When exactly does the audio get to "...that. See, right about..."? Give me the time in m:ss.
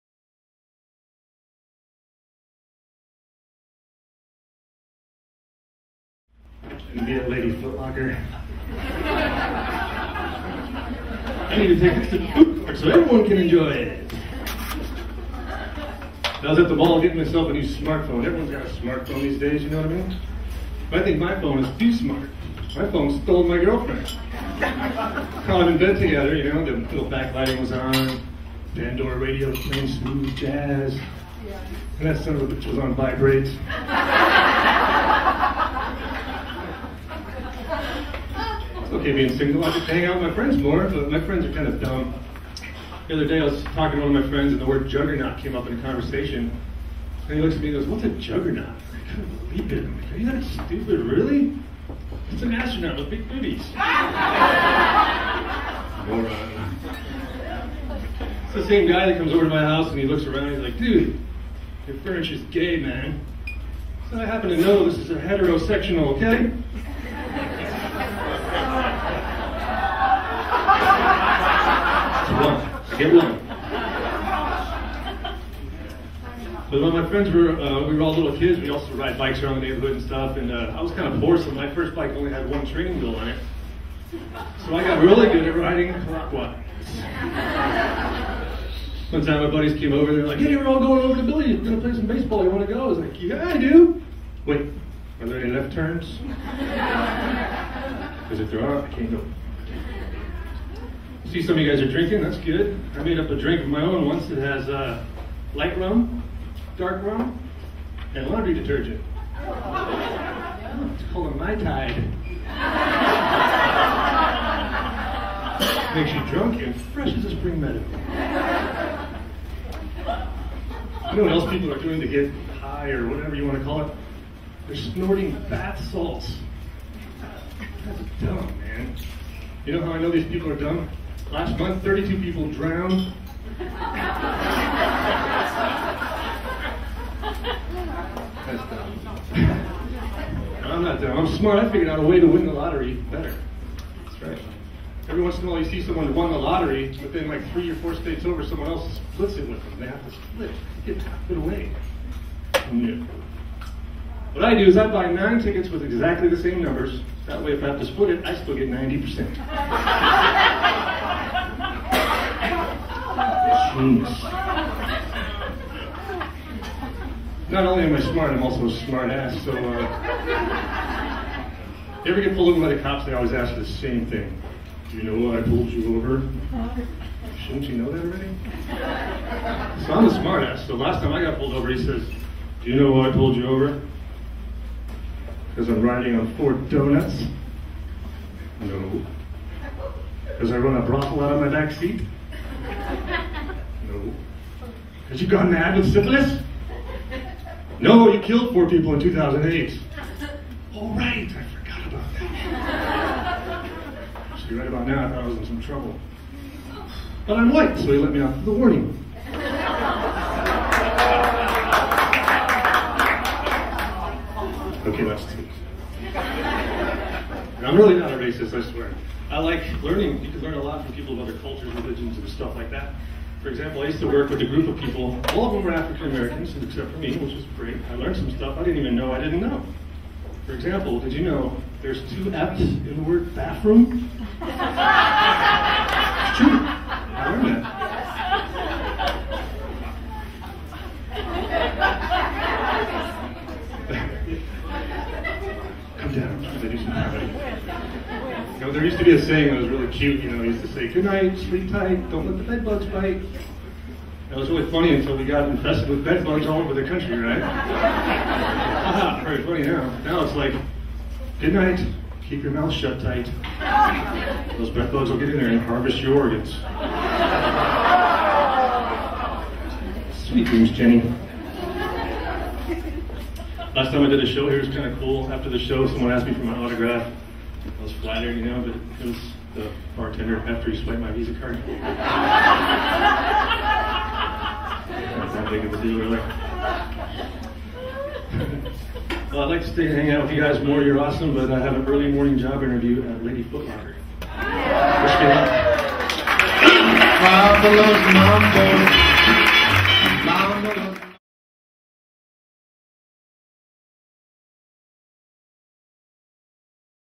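3:23.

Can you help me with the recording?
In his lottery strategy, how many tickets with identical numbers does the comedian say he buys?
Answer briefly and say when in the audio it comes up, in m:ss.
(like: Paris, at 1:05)
9, at 2:35.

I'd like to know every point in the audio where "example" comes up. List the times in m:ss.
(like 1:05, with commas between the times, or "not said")
3:43, 3:50.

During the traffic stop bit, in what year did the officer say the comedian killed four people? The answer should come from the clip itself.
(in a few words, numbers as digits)
2008.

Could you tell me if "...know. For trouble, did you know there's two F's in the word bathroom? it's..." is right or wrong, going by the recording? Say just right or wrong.
wrong.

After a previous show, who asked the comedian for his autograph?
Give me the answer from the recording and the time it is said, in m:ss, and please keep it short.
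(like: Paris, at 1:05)
the bartender, at 4:39.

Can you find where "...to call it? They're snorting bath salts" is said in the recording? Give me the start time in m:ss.
2:03.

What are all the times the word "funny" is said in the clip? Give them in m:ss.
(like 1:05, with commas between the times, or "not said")
4:14, 4:19.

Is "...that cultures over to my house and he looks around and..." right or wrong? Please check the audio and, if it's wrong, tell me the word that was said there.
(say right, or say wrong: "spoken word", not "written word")
wrong: "comes", not "cultures".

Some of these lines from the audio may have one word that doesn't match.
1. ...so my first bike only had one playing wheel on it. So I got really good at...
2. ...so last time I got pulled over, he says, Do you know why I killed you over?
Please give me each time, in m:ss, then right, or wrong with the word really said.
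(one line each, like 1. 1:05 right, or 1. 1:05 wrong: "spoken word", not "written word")
1. 1:21 wrong: "training", not "playing"
2. 3:00 wrong: "pulled", not "killed".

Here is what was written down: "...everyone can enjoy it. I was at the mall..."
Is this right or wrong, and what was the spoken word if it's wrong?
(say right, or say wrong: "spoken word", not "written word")
right.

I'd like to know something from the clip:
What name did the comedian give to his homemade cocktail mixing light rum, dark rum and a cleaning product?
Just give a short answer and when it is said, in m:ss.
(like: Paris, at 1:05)
Mai Tide, at 1:51.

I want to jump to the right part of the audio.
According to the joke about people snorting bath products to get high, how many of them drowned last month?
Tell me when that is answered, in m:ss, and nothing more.
2:11.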